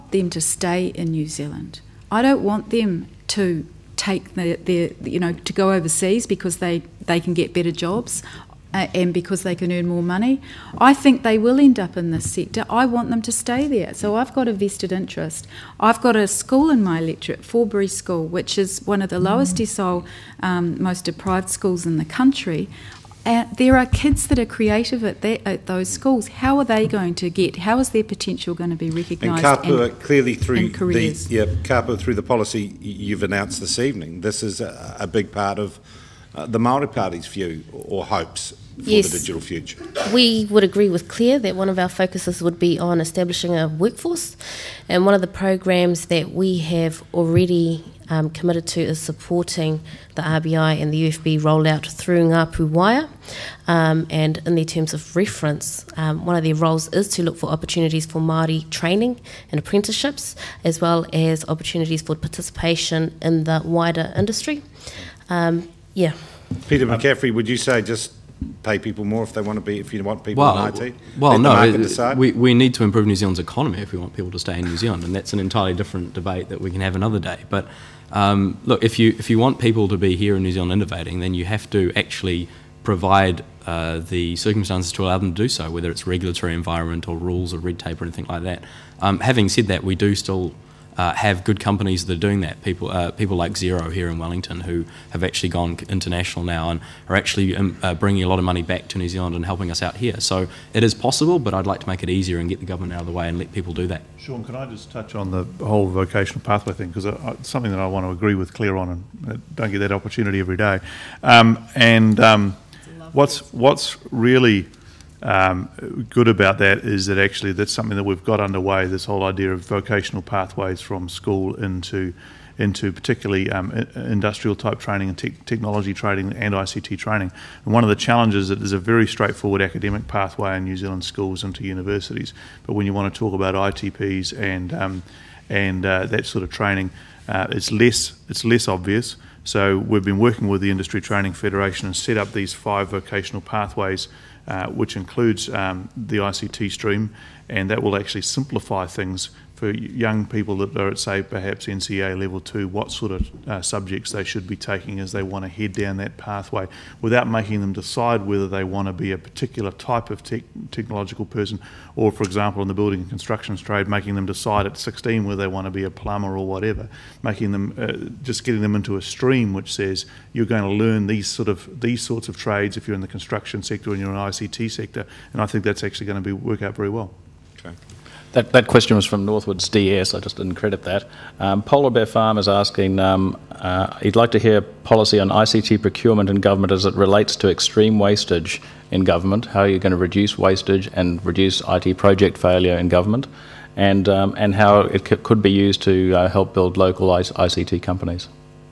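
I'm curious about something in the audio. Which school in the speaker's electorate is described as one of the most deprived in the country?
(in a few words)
Forbury School.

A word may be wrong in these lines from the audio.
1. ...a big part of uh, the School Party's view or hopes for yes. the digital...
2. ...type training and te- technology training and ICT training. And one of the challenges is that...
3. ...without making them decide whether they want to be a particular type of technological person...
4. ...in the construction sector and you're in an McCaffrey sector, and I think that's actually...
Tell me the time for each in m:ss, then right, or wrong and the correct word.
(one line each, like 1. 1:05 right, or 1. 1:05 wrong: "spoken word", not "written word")
1. 0:35 wrong: "Maori", not "School"
2. 2:04 right
3. 2:37 right
4. 2:52 wrong: "ICT", not "McCaffrey".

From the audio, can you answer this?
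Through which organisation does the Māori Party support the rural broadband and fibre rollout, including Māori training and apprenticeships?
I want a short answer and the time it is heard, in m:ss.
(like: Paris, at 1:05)
Ngā Pū Waea, at 0:52.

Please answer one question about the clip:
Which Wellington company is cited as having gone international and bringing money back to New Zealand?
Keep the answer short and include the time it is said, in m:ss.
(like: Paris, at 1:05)
Xero, at 1:33.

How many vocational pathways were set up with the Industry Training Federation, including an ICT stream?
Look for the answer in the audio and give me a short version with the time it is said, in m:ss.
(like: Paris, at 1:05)
5, at 2:22.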